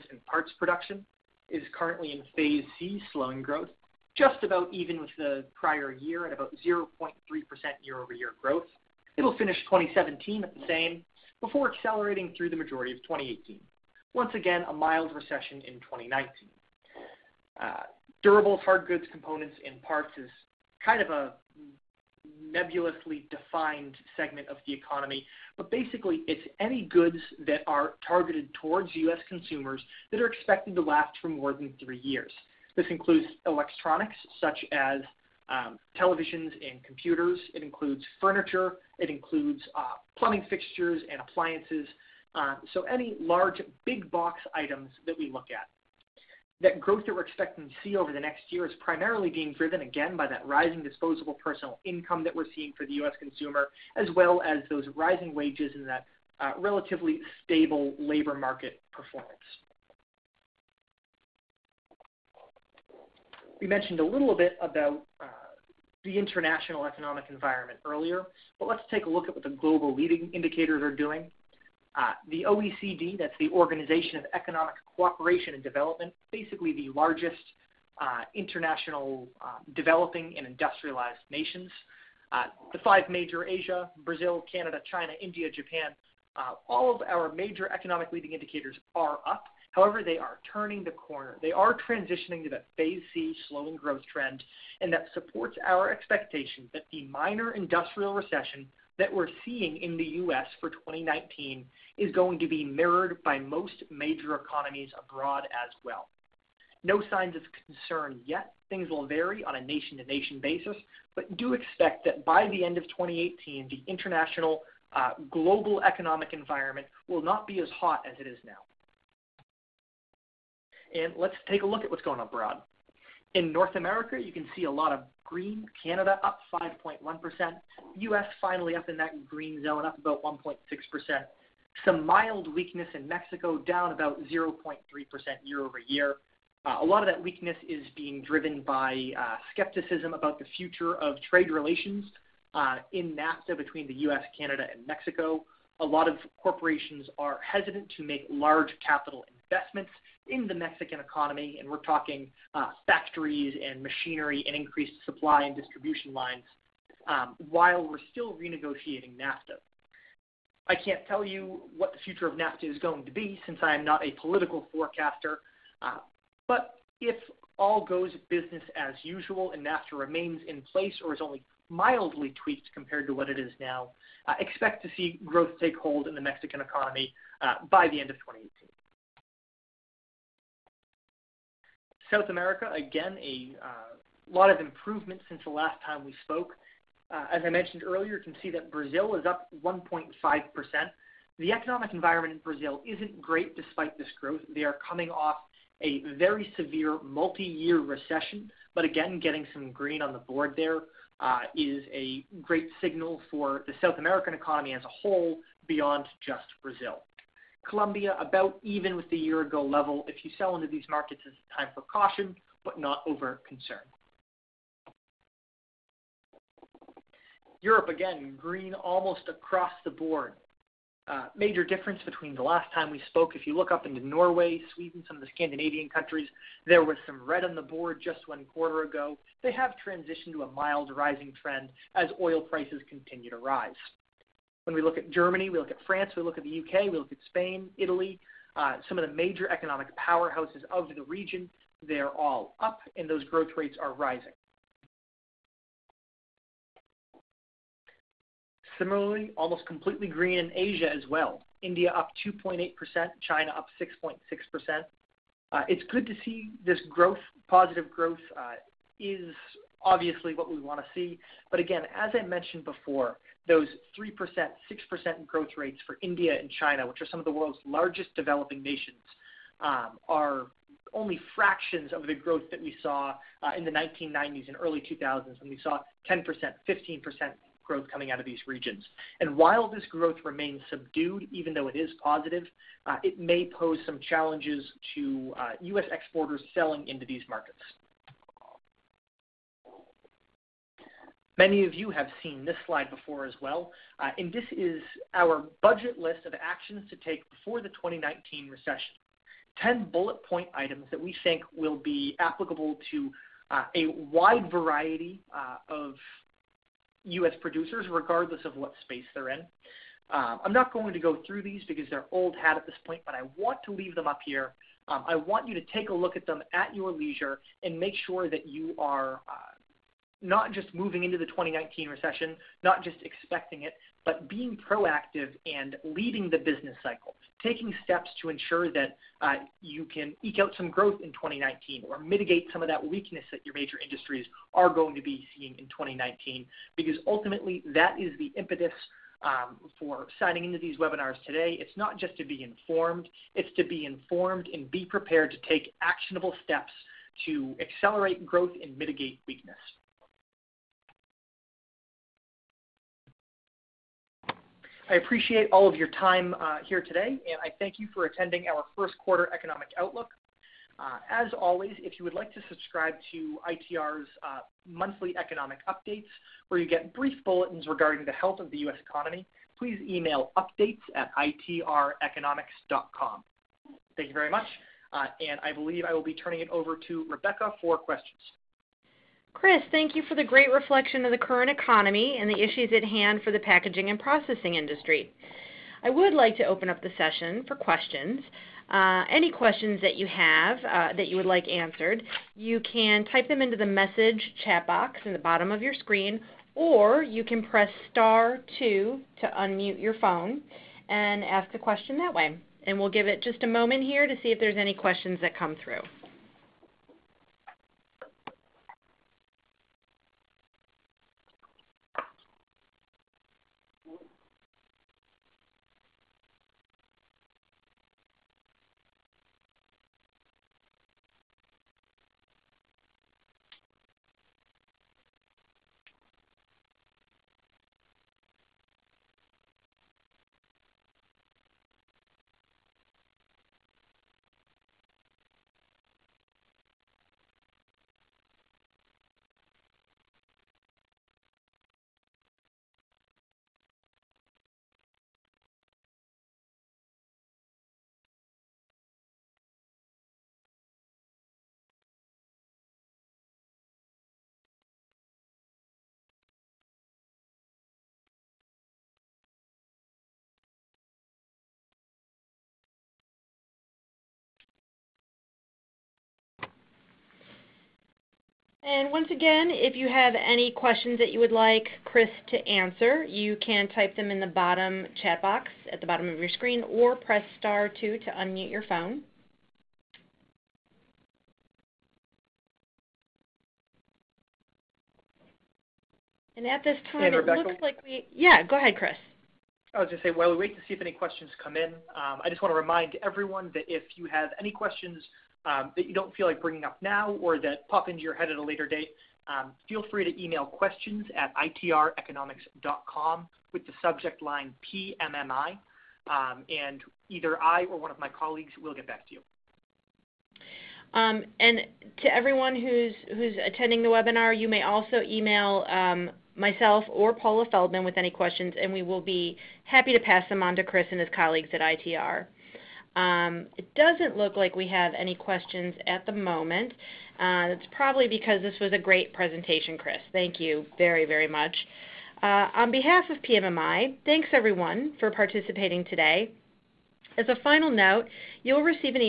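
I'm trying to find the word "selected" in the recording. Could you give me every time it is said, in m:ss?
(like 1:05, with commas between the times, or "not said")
not said.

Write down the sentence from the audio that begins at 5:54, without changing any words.
I appreciate all of your time uh, here today, and I thank you for attending our first quarter economic outlook.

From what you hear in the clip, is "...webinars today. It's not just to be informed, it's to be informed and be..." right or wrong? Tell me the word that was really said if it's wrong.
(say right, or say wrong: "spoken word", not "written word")
right.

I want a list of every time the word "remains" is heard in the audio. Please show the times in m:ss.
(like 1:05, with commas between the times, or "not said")
2:49, 4:40.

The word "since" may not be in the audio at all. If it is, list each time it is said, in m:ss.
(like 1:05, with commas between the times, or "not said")
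2:43, 3:05.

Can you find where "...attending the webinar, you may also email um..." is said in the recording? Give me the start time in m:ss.
8:33.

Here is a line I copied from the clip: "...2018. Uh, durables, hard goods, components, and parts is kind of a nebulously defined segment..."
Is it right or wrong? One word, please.
wrong.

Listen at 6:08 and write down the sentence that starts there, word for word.
economy, please email updates at Thank you very much, and I believe I will be turning it over to Rebecca for questions.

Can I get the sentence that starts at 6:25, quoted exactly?
I would like to open up the session for questions.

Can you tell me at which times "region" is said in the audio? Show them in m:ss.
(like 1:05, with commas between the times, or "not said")
4:01, 4:38.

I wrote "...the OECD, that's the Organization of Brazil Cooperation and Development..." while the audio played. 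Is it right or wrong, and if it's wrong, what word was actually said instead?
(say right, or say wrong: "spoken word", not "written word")
wrong: "Economic", not "Brazil".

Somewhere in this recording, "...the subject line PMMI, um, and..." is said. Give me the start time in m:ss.
8:23.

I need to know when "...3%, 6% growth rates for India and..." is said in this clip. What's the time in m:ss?
4:23.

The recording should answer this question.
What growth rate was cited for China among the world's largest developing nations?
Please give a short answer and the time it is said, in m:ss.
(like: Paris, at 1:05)
6.6%, at 4:13.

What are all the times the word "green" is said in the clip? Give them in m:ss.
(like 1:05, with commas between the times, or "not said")
2:05, 2:09, 3:19, 3:38, 4:10.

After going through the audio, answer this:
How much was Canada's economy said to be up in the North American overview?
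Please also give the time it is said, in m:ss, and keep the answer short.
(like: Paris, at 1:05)
5.1%, at 2:06.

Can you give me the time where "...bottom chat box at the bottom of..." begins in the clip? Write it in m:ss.
7:54.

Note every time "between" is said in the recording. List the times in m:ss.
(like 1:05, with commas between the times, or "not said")
2:23, 3:42.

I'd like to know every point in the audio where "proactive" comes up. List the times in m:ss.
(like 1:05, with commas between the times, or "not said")
5:24.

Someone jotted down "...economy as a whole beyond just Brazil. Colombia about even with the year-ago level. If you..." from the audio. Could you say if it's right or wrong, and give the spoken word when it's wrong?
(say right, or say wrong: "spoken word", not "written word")
right.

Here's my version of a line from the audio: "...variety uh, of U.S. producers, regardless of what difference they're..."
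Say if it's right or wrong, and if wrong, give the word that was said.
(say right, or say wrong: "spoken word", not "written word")
wrong: "space", not "difference".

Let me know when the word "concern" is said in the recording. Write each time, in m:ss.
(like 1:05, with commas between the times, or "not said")
1:47, 3:33.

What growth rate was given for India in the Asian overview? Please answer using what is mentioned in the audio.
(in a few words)
2.8%.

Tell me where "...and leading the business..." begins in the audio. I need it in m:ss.
5:25.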